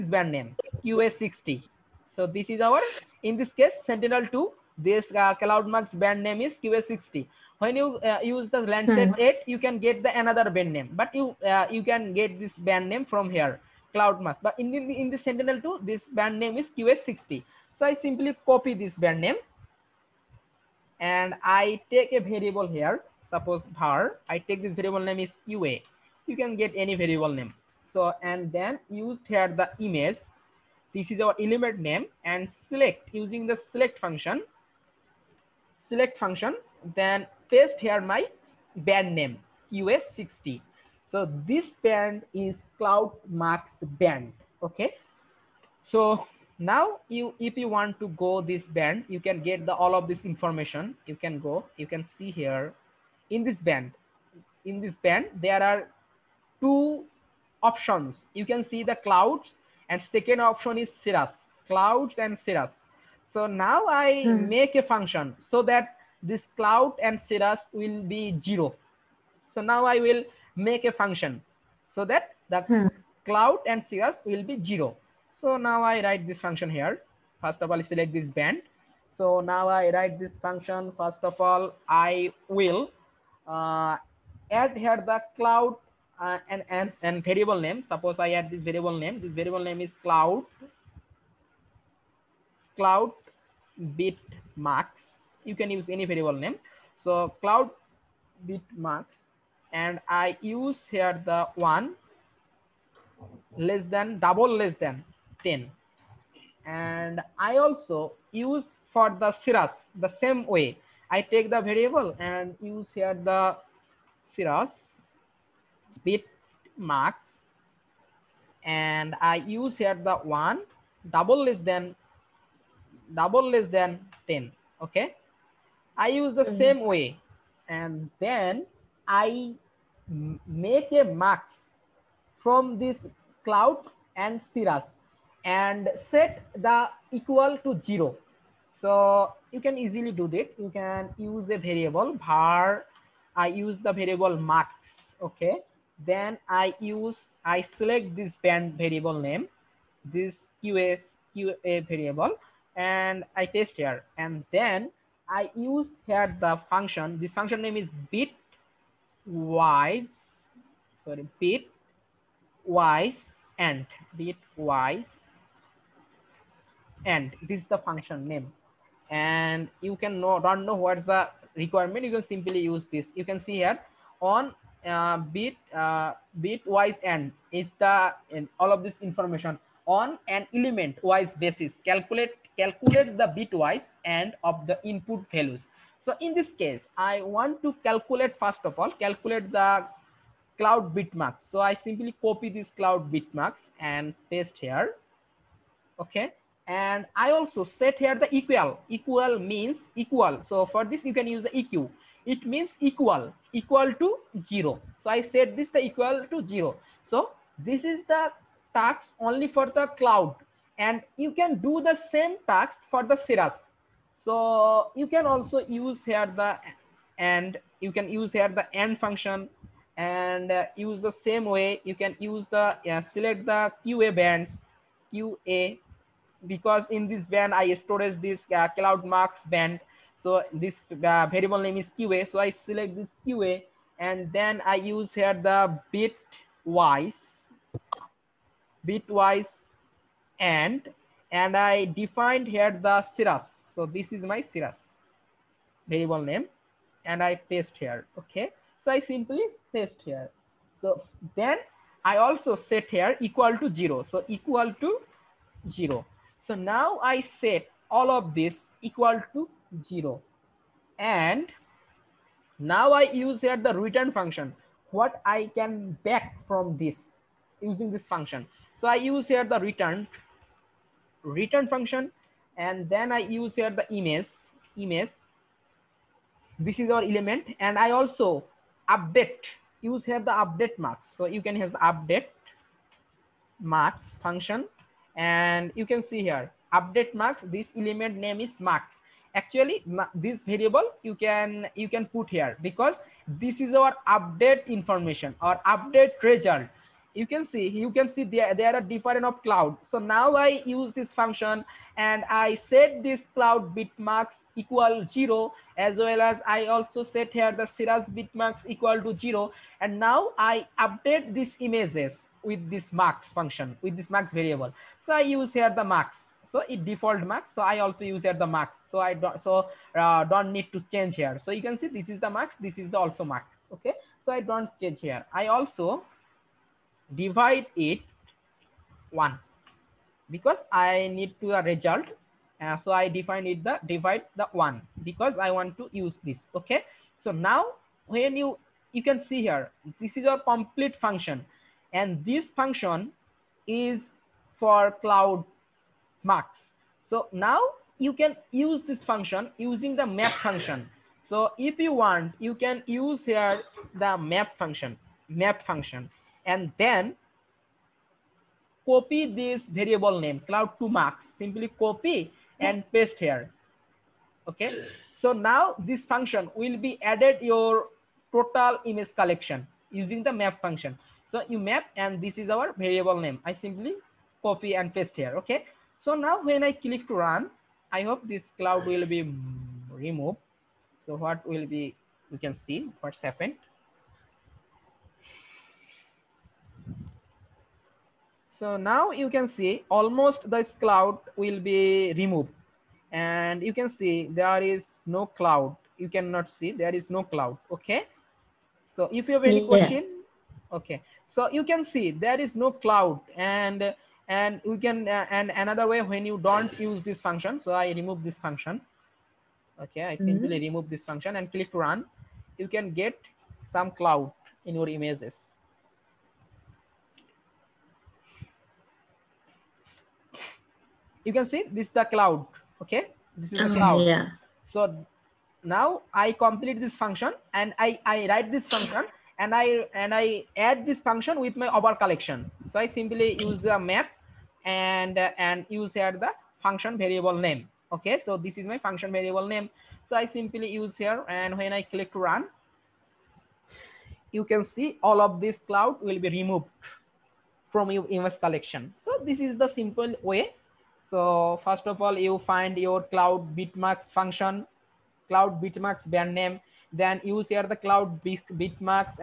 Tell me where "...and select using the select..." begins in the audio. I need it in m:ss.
0:32.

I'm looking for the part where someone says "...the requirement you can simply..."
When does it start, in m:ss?
2:51.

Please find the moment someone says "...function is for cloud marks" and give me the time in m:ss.
5:42.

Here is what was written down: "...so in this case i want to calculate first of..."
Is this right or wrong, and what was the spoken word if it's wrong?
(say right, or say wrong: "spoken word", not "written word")
right.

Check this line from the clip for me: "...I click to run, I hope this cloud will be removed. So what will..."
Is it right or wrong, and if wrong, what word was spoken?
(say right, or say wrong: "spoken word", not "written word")
right.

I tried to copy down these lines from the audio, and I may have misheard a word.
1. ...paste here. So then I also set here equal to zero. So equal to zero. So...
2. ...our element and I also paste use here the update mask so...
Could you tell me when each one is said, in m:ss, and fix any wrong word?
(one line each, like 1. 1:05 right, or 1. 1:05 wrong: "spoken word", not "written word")
1. 4:09 right
2. 4:36 wrong: "update", not "paste".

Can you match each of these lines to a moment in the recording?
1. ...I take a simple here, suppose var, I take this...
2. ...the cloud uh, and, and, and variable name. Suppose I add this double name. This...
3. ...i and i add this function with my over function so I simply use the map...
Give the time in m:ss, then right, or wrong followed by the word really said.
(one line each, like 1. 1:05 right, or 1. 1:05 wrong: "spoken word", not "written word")
1. 0:21 wrong: "variable", not "simple"
2. 1:25 wrong: "variable", not "double"
3. 7:09 wrong: "collection", not "function".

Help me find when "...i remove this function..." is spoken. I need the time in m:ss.
6:47.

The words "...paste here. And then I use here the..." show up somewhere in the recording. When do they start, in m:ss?
2:33.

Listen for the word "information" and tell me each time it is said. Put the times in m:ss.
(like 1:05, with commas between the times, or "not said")
0:50, 2:59, 4:54.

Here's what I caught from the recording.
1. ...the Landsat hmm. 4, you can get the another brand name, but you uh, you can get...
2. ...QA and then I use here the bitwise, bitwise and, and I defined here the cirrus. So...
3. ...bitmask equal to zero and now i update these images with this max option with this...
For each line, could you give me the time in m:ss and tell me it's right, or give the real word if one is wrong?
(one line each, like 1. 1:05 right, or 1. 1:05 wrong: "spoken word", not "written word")
1. 0:08 wrong: "8", not "4"
2. 3:53 right
3. 5:08 wrong: "function", not "option".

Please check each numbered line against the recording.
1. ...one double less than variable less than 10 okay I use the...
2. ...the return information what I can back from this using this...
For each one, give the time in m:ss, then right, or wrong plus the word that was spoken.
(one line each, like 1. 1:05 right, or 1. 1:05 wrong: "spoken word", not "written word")
1. 2:00 wrong: "double", not "variable"
2. 4:23 wrong: "function", not "information".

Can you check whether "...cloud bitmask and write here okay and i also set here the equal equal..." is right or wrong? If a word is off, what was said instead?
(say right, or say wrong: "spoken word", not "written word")
wrong: "paste", not "write".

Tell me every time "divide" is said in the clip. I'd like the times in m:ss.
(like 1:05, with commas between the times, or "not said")
5:27, 5:33.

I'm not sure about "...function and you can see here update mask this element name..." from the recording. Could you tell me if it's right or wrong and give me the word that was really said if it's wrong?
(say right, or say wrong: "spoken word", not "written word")
right.